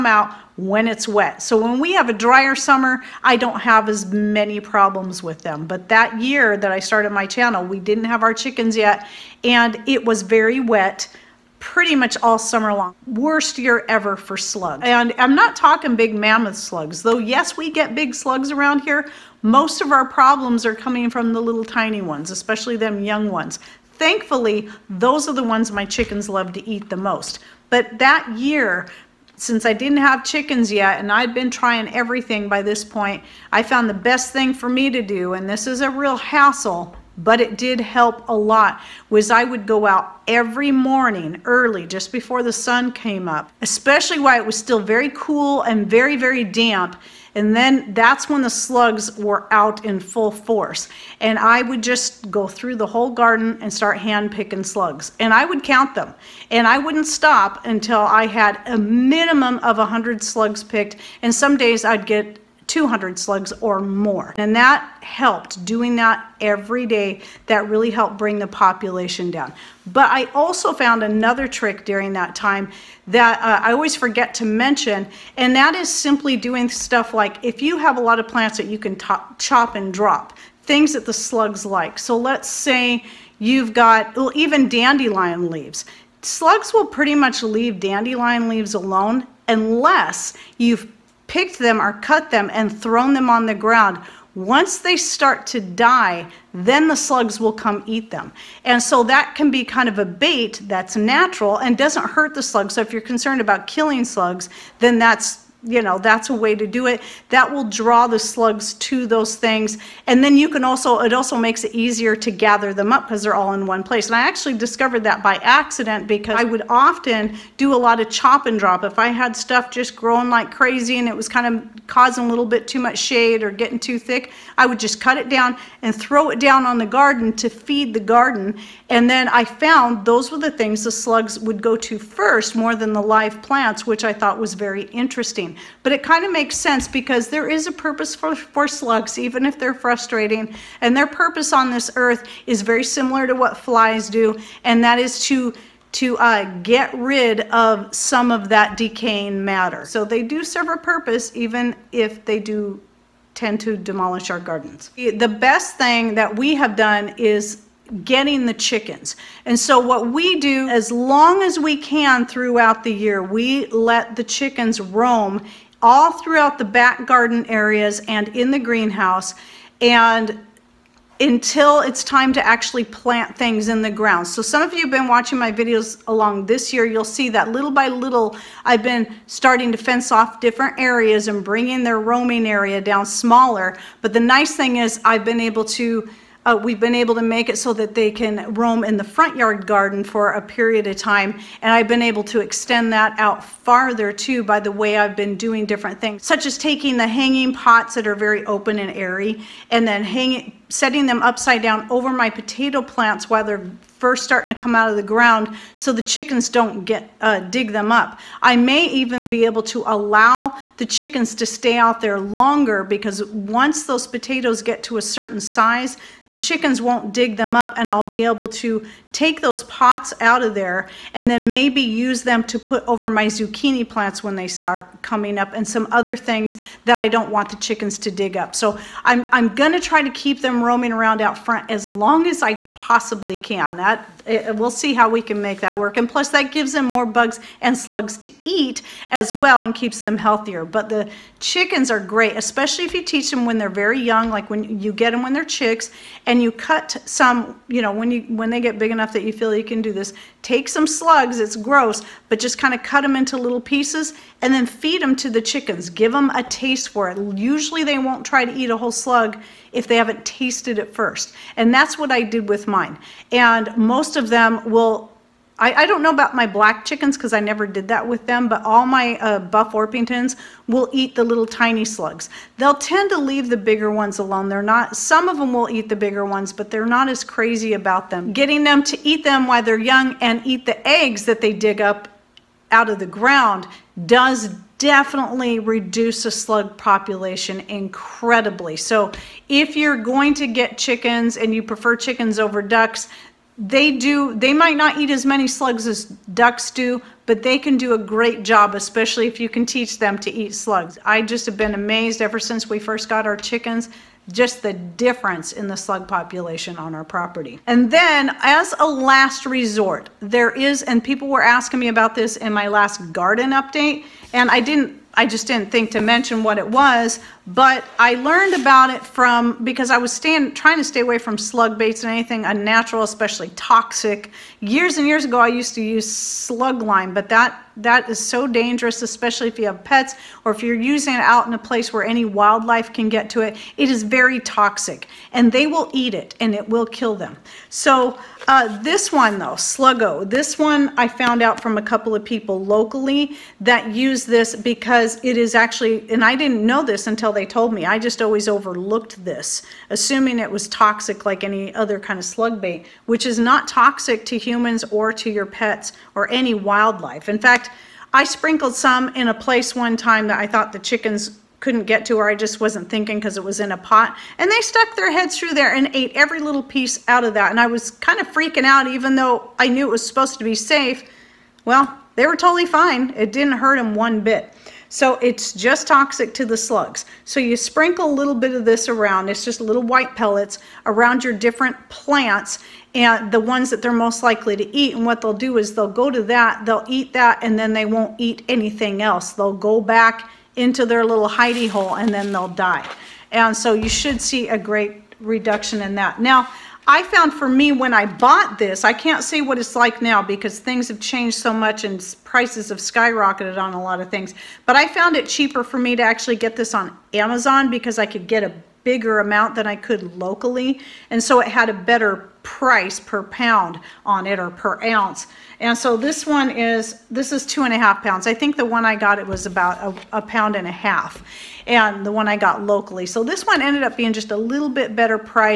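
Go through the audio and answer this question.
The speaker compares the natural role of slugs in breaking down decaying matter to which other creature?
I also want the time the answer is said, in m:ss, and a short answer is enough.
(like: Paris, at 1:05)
Flies, at 2:23.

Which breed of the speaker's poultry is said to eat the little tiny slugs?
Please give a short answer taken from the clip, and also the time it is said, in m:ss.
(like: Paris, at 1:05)
Buff Orpingtons, at 4:29.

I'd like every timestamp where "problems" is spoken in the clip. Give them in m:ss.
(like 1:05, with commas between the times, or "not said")
0:04, 0:20.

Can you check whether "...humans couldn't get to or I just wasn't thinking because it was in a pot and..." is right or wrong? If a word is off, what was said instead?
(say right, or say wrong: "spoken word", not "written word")
wrong: "chickens", not "humans".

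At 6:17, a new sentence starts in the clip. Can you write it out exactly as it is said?
So you sprinkle a little bit of this around.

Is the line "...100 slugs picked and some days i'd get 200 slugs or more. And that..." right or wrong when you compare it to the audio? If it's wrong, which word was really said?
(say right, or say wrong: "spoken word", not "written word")
right.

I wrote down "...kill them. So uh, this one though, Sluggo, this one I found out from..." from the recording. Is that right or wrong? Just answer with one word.
right.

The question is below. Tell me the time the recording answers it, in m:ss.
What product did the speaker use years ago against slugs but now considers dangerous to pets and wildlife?
5:26.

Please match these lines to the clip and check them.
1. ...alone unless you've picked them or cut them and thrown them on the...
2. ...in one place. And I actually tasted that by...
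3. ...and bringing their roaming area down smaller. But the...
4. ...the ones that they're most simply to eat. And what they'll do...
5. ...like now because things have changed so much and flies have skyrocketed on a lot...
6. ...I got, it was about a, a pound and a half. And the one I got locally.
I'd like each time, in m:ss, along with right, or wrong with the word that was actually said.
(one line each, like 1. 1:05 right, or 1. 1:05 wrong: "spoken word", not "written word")
1. 1:28 right
2. 1:53 wrong: "discovered", not "tasted"
3. 3:01 right
4. 6:23 wrong: "likely", not "simply"
5. 6:39 wrong: "prices", not "flies"
6. 6:58 right.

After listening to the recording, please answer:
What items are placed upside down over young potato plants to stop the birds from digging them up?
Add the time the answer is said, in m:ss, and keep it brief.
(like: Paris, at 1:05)
Hanging pots, at 3:17.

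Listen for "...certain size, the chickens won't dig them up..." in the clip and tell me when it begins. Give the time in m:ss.
3:35.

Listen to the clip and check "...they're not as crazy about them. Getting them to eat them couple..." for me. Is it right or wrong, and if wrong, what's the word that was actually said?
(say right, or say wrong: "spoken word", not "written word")
wrong: "while", not "couple".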